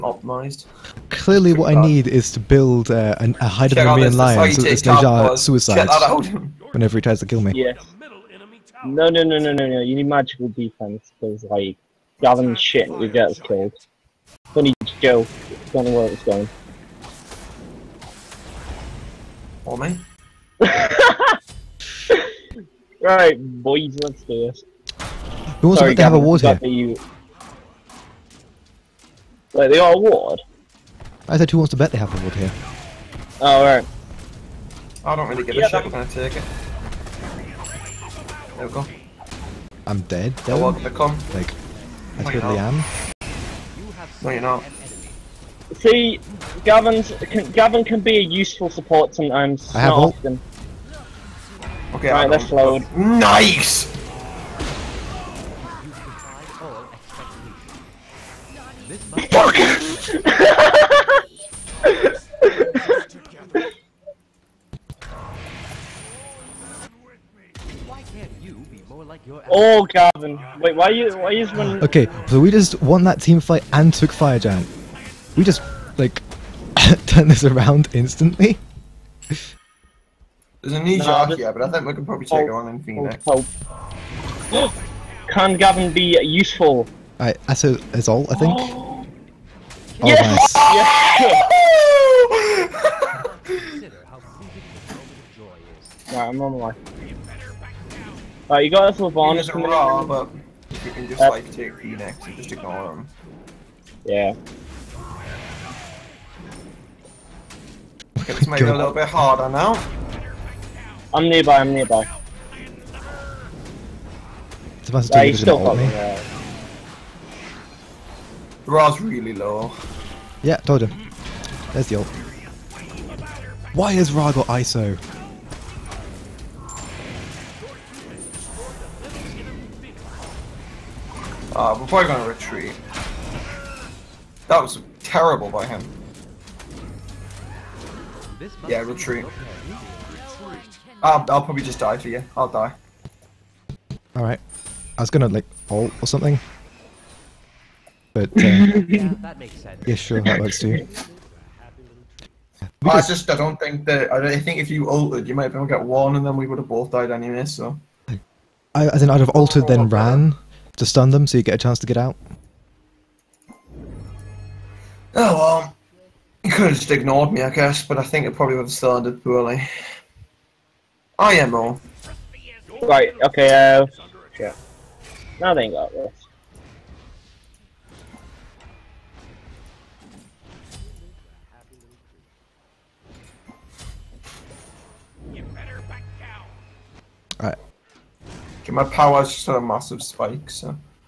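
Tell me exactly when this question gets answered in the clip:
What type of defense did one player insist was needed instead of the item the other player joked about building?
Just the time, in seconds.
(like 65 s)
10 s.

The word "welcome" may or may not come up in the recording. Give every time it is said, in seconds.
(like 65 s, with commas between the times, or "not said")
40 s.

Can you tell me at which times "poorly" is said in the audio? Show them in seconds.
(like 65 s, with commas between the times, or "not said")
169 s.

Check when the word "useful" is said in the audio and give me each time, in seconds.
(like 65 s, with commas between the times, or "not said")
48 s, 86 s.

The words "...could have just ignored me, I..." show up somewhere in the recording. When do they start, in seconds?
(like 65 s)
166 s.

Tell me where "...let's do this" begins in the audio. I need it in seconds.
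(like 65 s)
24 s.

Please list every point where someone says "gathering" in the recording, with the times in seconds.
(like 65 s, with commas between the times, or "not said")
12 s.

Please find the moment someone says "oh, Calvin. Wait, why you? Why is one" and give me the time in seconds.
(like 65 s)
69 s.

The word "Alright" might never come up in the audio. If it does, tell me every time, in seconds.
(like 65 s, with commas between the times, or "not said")
87 s, 98 s, 144 s.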